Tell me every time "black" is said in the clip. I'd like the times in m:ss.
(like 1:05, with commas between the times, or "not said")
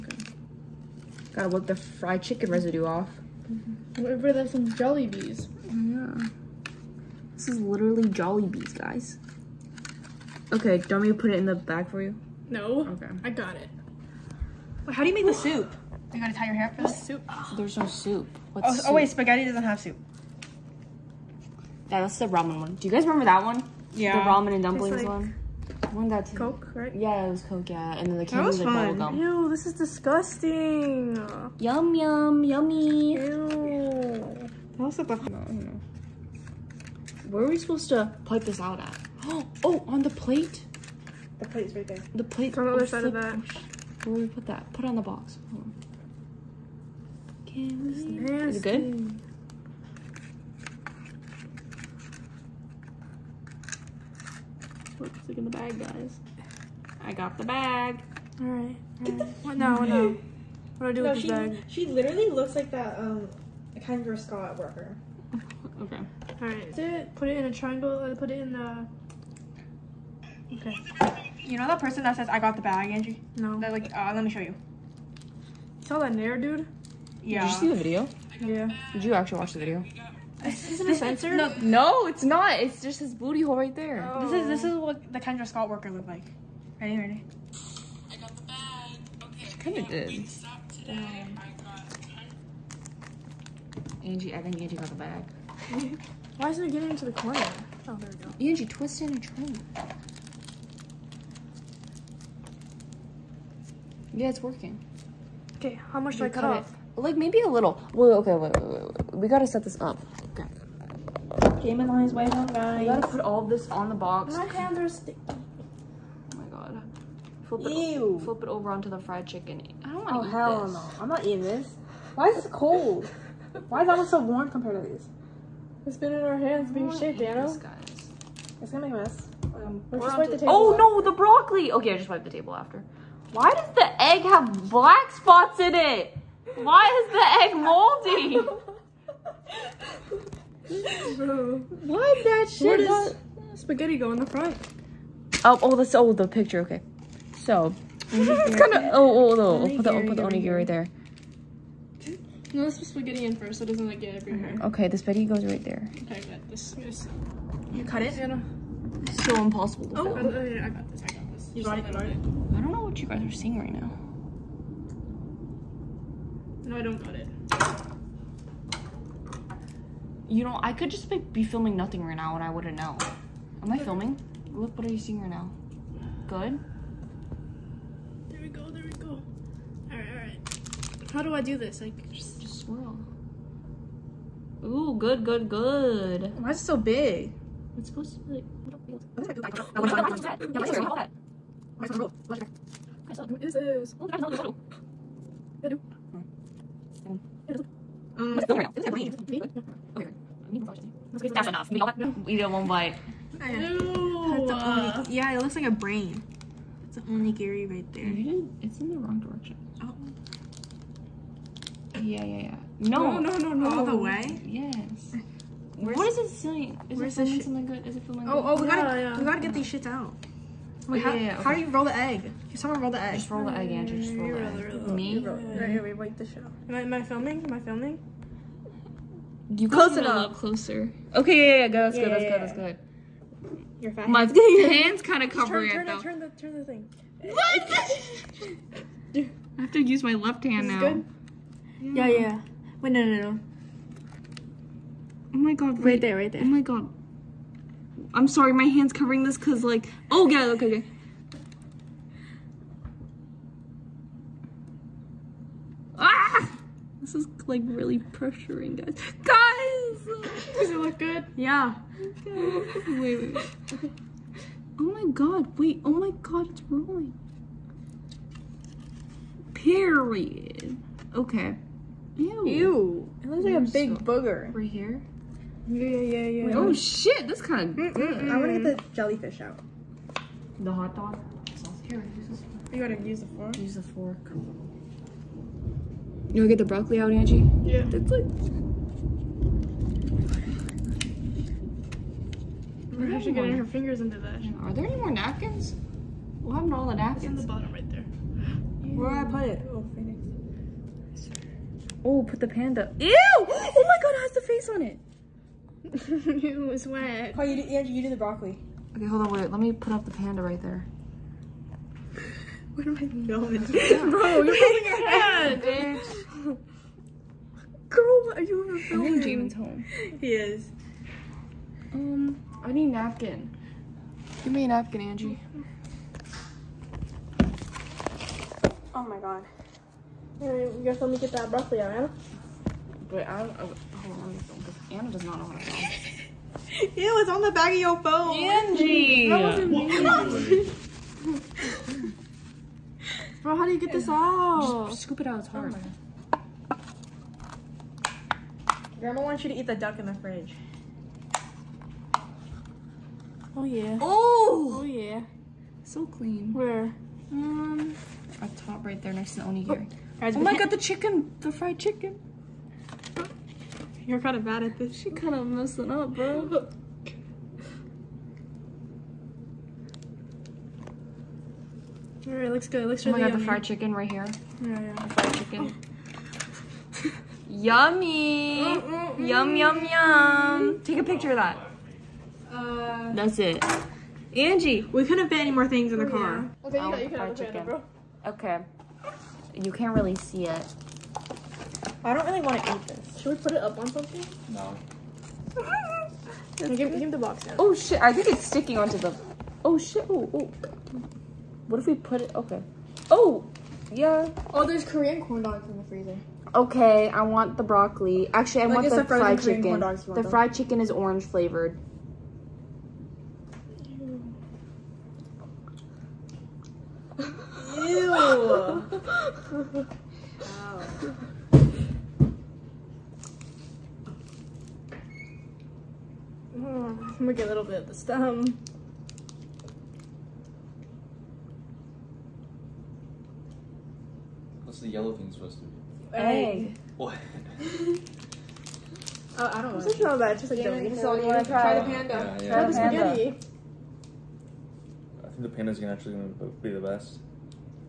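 2:14.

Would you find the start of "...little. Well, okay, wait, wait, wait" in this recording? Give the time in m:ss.
1:47.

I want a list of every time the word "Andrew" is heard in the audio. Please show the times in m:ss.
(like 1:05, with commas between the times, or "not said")
3:43, 5:07.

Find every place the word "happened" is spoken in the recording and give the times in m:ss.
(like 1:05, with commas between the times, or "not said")
4:56.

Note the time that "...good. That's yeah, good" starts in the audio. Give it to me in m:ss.
3:52.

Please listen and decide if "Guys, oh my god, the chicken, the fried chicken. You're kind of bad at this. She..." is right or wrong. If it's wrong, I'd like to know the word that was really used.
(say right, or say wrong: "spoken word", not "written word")
right.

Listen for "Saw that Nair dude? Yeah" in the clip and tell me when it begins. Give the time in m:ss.
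1:15.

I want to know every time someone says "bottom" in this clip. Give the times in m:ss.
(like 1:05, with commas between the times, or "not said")
4:57.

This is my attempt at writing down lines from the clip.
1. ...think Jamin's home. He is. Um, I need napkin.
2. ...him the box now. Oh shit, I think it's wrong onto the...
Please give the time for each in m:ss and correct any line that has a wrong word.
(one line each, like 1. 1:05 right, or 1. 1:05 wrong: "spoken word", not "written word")
1. 5:19 right
2. 6:36 wrong: "sticking", not "wrong".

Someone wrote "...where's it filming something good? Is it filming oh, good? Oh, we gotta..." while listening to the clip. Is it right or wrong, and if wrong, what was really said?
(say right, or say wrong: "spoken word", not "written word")
right.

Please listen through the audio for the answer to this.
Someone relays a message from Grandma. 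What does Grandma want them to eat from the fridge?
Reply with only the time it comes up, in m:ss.
5:49.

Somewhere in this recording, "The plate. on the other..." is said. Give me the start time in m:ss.
0:42.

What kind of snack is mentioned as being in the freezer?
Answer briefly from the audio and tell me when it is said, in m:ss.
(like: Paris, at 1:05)
Korean corn dogs, at 6:44.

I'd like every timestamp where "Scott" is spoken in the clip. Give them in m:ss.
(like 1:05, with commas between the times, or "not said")
1:04, 1:25.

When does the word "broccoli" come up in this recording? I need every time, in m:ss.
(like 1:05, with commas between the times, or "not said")
2:11, 4:46, 5:08, 5:31, 6:47.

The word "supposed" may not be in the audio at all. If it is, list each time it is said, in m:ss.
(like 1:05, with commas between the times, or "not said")
0:37, 3:07, 7:15.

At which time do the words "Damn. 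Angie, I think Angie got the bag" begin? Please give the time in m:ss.
1:30.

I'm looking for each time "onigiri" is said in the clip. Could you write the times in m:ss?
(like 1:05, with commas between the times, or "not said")
2:30, 3:27, 5:59.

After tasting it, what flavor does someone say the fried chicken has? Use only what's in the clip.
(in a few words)
Orange.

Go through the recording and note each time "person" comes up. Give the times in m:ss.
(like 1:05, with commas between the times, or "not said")
1:11.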